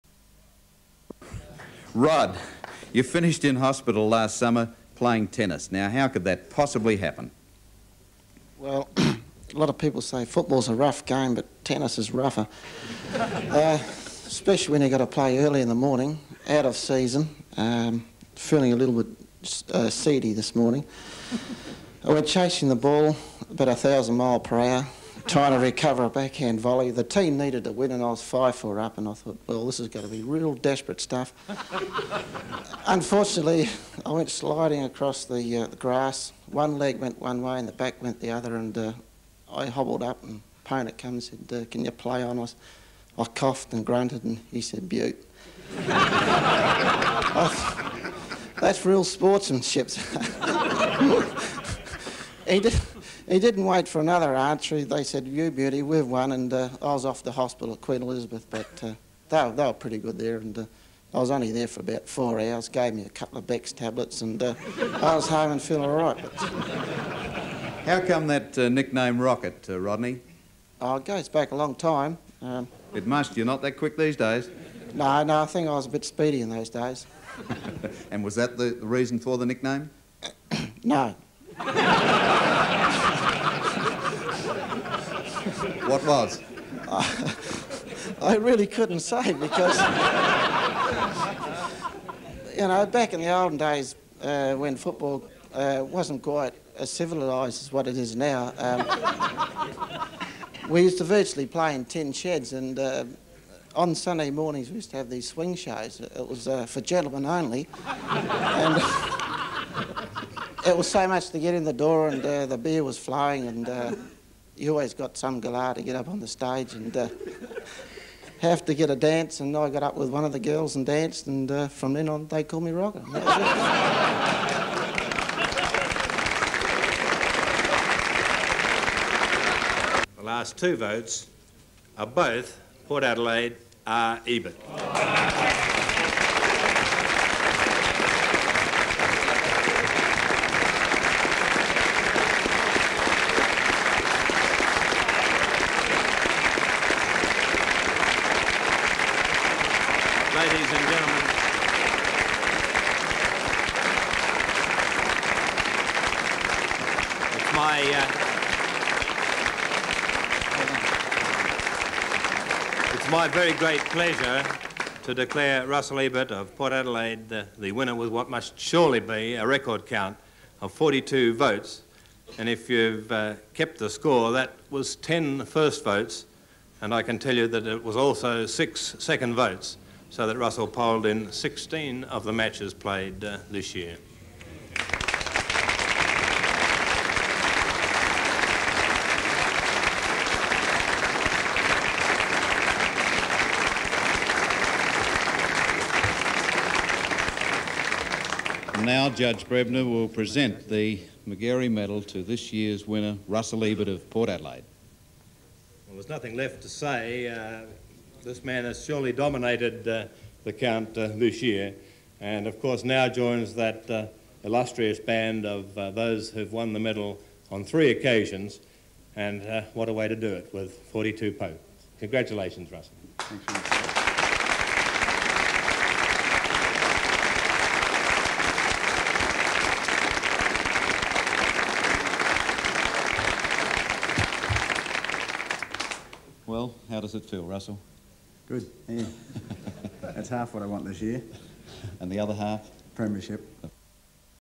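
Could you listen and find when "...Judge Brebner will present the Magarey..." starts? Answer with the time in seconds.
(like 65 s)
199 s.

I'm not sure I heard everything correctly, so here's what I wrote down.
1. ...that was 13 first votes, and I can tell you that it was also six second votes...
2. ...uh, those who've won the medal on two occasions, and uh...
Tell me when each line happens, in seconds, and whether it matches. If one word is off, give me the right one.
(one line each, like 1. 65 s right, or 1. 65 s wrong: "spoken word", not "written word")
1. 174 s wrong: "10", not "13"
2. 215 s wrong: "three", not "two".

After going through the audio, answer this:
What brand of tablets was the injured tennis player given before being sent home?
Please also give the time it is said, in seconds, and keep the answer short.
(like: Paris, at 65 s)
Bex, at 63 s.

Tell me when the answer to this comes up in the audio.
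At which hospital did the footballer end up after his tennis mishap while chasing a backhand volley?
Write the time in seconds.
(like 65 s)
57 s.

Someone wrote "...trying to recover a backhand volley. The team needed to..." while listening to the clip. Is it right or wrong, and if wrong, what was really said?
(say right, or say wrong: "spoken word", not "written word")
right.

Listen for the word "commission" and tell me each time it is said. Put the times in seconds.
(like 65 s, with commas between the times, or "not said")
not said.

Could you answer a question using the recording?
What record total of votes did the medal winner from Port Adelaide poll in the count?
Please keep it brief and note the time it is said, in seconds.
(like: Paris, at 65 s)
42, at 170 s.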